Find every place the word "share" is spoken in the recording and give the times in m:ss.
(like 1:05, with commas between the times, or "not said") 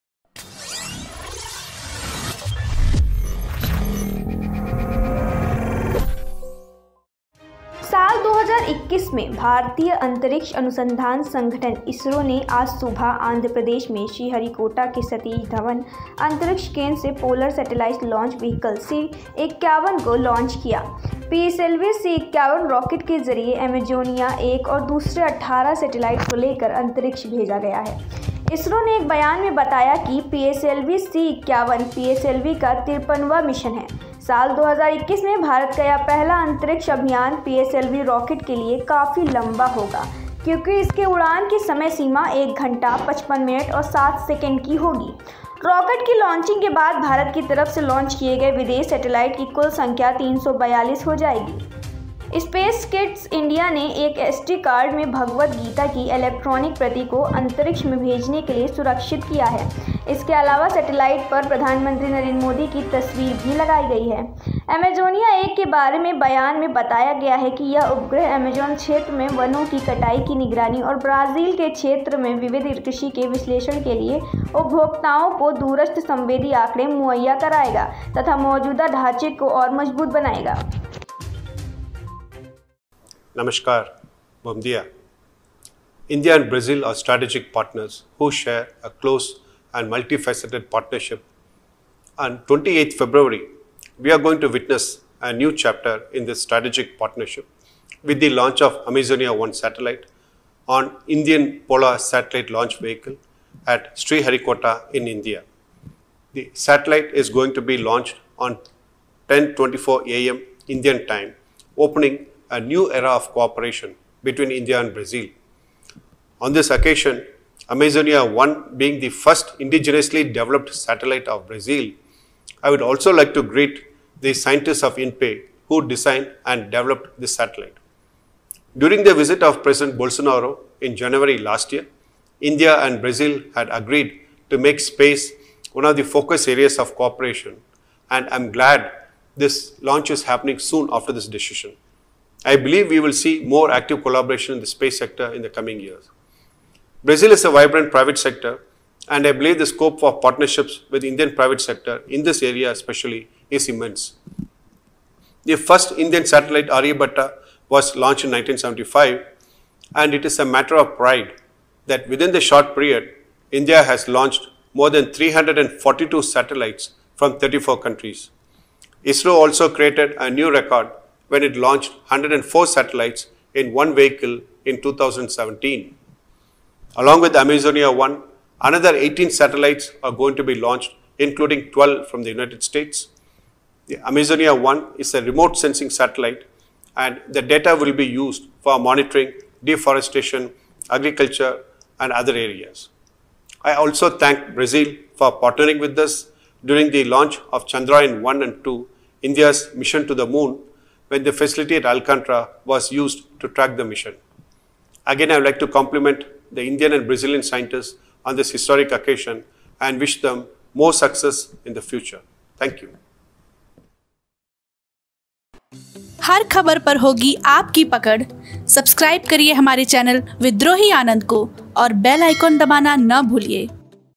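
1:28.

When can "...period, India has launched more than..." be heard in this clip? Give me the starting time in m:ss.
2:42.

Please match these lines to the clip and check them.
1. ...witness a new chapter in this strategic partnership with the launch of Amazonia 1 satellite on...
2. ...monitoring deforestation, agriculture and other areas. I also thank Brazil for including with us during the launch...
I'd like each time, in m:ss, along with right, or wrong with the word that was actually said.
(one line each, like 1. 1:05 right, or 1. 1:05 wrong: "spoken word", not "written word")
1. 1:34 right
2. 3:08 wrong: "partnering", not "including".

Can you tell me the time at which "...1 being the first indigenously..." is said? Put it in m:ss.
1:58.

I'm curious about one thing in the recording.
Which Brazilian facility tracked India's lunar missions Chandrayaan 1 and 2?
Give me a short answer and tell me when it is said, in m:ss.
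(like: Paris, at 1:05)
Alcantara, at 3:21.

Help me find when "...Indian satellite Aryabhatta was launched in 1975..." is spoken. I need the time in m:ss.
2:35.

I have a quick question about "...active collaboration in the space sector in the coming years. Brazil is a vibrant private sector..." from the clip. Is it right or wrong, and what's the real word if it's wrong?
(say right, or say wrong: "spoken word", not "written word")
right.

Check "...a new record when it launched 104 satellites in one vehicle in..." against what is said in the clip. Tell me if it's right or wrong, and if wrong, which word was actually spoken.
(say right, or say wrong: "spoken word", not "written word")
right.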